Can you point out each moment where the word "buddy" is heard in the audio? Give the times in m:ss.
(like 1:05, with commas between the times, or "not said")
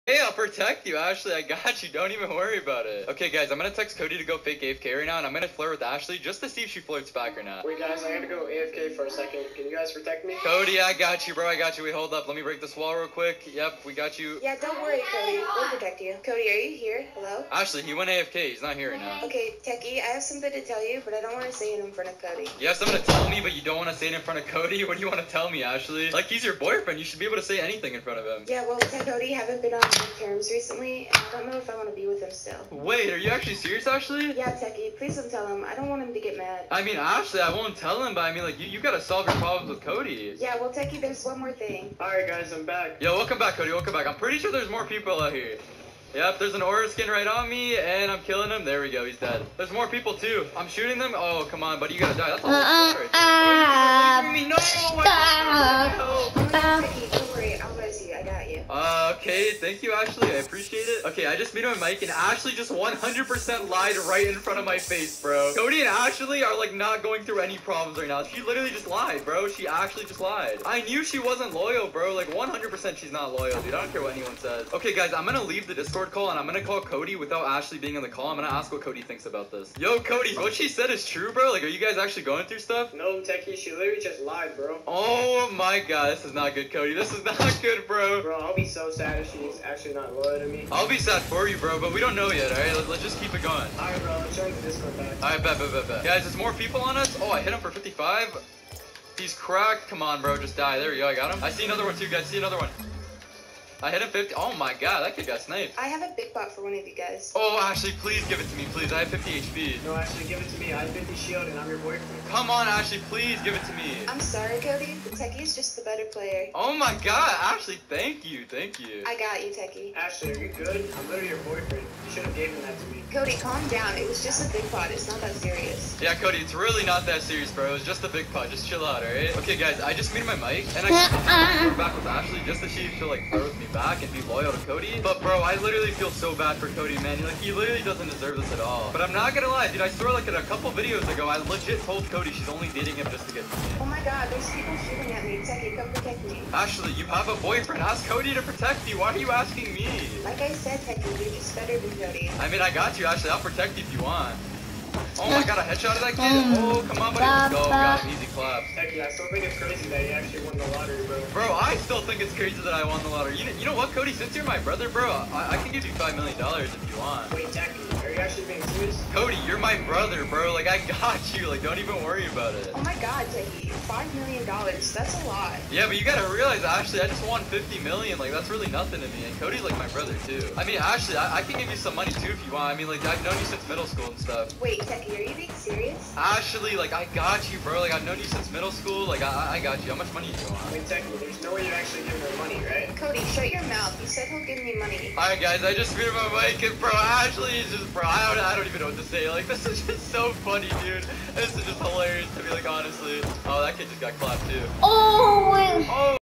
0:51, 2:37.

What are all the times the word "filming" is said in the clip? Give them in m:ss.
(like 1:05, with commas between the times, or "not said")
not said.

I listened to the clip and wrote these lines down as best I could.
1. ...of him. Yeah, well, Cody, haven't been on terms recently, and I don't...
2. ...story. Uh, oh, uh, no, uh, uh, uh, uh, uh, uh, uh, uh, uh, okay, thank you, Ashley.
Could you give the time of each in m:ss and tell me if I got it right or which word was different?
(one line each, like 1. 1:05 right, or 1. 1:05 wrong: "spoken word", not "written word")
1. 0:28 right
2. 0:52 right.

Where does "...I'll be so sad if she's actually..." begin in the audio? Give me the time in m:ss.
1:28.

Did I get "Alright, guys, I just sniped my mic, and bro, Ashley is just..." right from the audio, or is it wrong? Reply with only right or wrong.
wrong.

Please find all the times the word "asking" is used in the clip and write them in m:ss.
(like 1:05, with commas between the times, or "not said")
2:29.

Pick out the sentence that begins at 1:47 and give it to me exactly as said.
Oh, Ashley, please give it to me, please.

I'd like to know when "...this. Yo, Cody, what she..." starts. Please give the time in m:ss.
1:19.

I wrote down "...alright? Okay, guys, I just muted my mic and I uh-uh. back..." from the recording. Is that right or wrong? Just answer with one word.
right.